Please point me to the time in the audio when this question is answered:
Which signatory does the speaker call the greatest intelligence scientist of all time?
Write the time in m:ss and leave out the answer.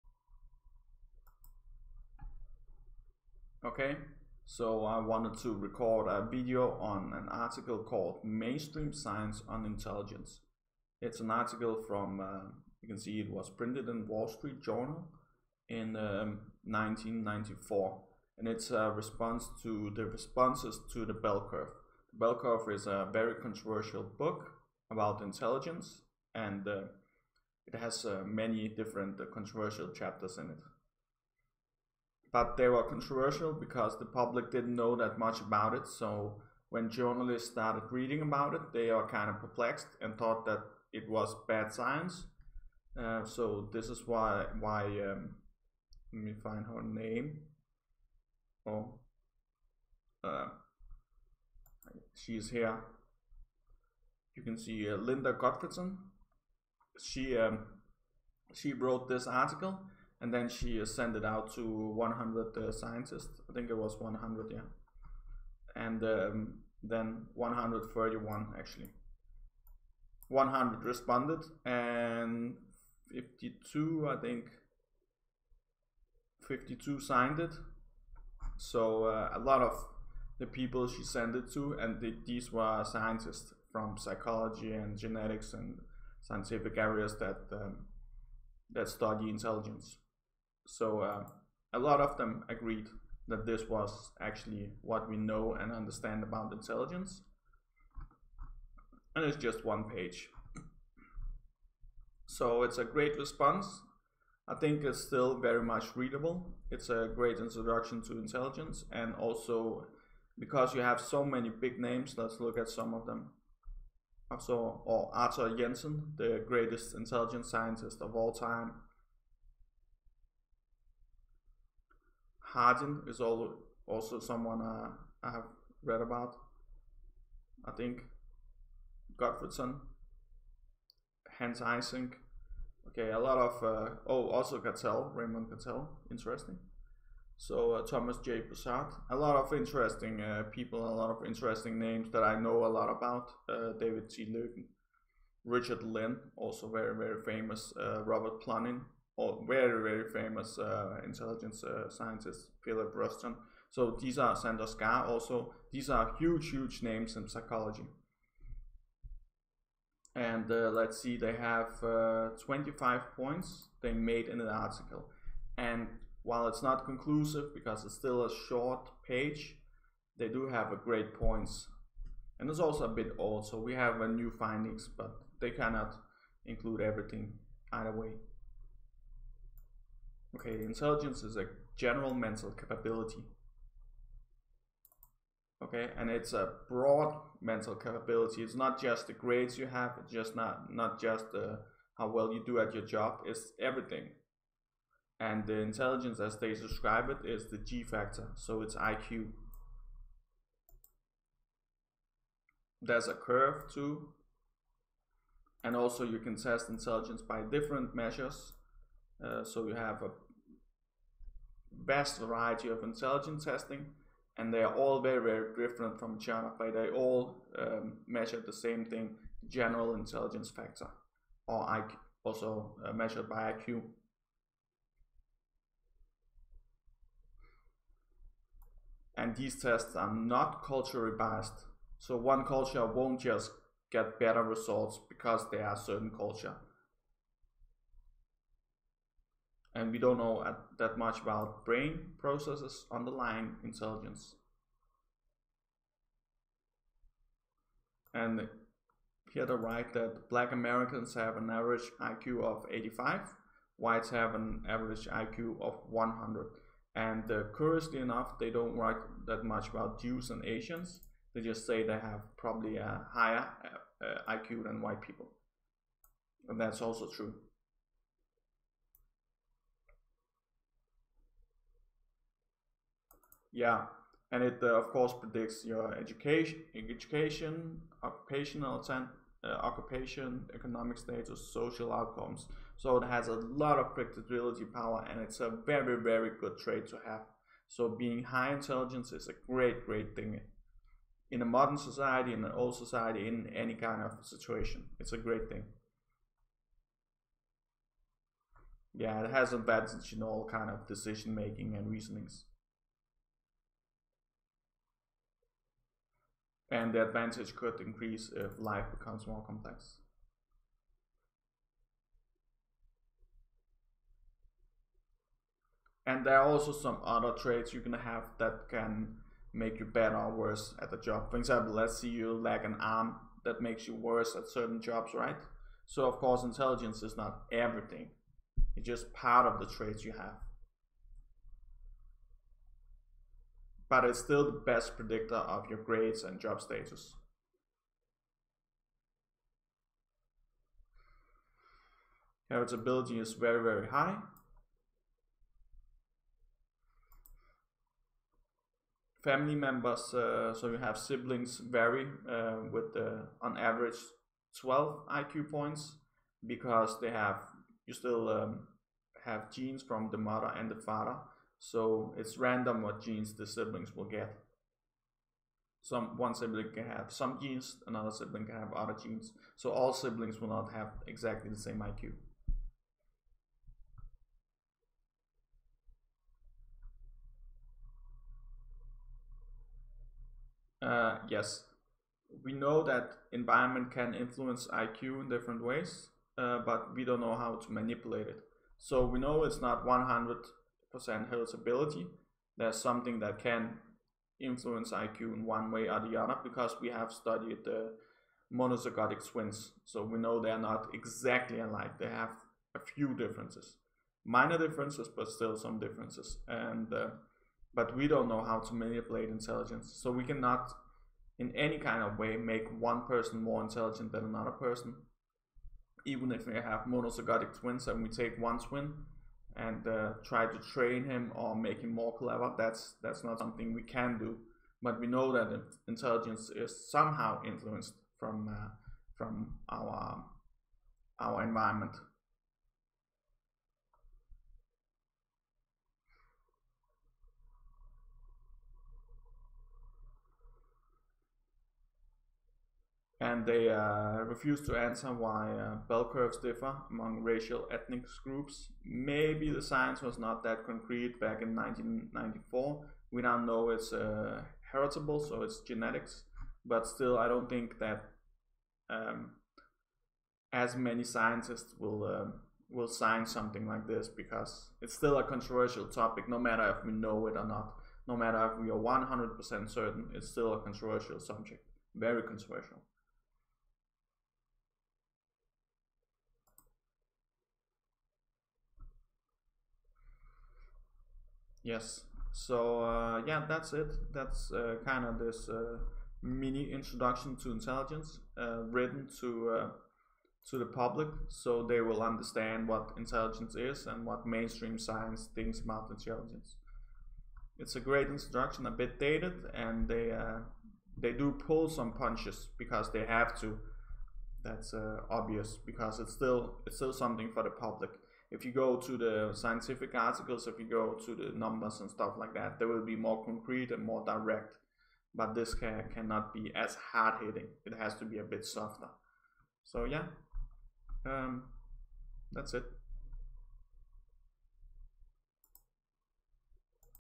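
1:55.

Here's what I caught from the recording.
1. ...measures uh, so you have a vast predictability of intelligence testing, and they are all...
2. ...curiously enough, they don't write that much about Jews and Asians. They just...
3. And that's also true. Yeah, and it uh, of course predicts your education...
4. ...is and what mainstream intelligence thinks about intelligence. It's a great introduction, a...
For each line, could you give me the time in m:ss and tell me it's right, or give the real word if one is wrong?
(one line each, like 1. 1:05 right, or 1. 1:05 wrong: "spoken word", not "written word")
1. 3:27 wrong: "variety", not "predictability"
2. 4:17 right
3. 4:26 right
4. 8:13 wrong: "science", not "intelligence".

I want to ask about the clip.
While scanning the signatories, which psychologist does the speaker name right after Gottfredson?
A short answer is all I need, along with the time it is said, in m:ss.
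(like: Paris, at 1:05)
Hans Eysenck, at 2:11.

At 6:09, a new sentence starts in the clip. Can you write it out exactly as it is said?
So all siblings will not have exactly the same IQ.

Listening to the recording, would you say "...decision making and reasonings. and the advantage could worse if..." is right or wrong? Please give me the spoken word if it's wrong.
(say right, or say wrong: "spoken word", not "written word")
wrong: "increase", not "worse".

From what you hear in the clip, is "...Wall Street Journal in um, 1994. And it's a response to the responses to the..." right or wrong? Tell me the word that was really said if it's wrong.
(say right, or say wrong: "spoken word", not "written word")
right.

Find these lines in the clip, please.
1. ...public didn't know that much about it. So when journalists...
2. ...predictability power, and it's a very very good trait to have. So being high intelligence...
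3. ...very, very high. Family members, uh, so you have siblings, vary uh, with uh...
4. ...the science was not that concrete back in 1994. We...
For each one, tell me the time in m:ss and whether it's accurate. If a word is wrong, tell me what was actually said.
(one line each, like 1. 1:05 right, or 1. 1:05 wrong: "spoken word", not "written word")
1. 0:34 right
2. 4:43 right
3. 5:43 right
4. 7:29 right.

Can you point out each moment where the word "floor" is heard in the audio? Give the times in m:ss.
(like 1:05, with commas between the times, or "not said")
not said.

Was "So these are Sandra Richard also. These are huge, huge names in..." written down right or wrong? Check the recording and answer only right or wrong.
wrong.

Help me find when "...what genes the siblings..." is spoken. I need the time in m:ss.
6:02.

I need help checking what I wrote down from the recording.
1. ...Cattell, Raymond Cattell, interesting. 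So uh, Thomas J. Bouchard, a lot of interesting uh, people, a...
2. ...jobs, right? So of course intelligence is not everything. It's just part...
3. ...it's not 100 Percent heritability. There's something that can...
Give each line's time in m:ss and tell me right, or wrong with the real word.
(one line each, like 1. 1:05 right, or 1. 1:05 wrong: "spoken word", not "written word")
1. 2:14 right
2. 5:24 right
3. 6:29 right.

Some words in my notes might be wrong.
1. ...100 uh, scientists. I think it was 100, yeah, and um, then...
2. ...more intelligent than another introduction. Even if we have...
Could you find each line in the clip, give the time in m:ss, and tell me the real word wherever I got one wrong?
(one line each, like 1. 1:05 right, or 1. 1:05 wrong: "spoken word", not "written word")
1. 1:01 right
2. 6:53 wrong: "person", not "introduction".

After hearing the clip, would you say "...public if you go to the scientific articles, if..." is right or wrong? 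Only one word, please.
right.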